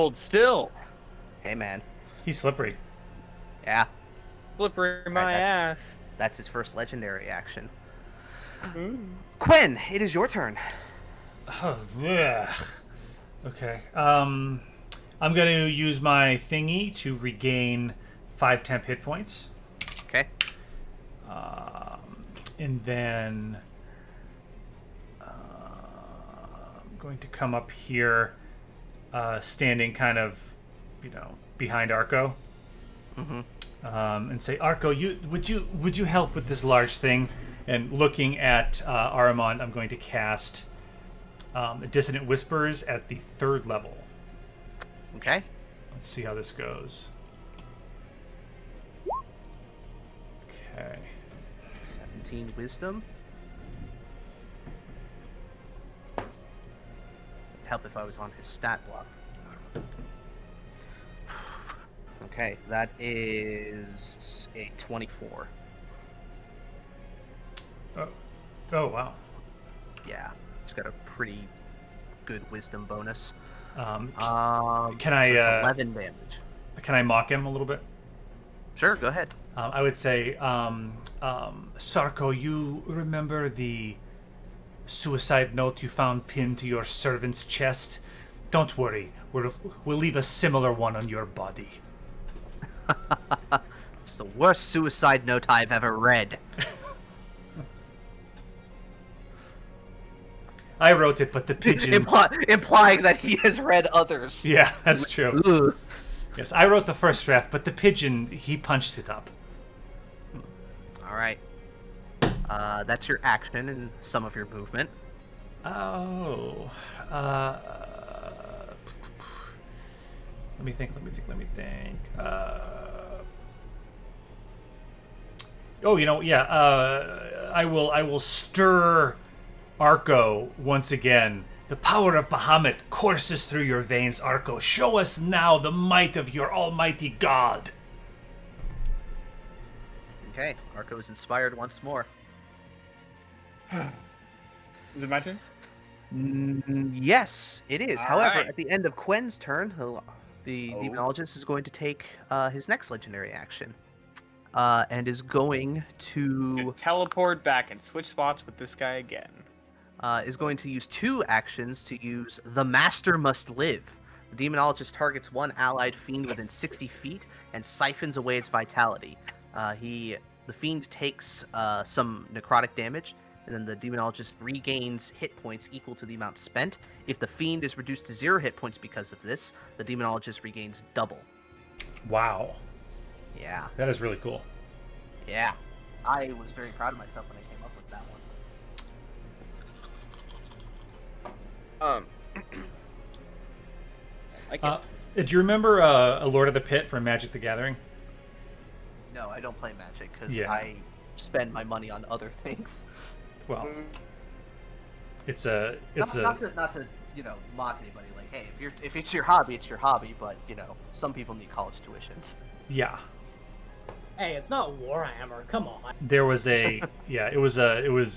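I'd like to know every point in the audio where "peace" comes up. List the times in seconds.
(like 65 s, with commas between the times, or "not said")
not said.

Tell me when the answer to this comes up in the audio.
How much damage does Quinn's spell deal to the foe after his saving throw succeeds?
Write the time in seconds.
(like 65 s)
75 s.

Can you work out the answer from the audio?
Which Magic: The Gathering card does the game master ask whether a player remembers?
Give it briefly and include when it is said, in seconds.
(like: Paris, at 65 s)
Lord of the Pit, at 196 s.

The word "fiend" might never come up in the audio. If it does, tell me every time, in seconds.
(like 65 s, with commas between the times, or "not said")
165 s, 170 s, 177 s.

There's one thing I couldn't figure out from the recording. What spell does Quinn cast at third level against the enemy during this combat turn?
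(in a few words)
Dissonant Whispers.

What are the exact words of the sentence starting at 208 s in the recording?
Like, hey, if you're if it's your hobby, it's your hobby.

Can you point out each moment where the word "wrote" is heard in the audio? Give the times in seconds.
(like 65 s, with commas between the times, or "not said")
100 s, 106 s.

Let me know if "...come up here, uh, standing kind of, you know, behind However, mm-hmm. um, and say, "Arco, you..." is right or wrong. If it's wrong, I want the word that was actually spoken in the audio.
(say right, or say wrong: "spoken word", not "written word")
wrong: "Arco", not "However".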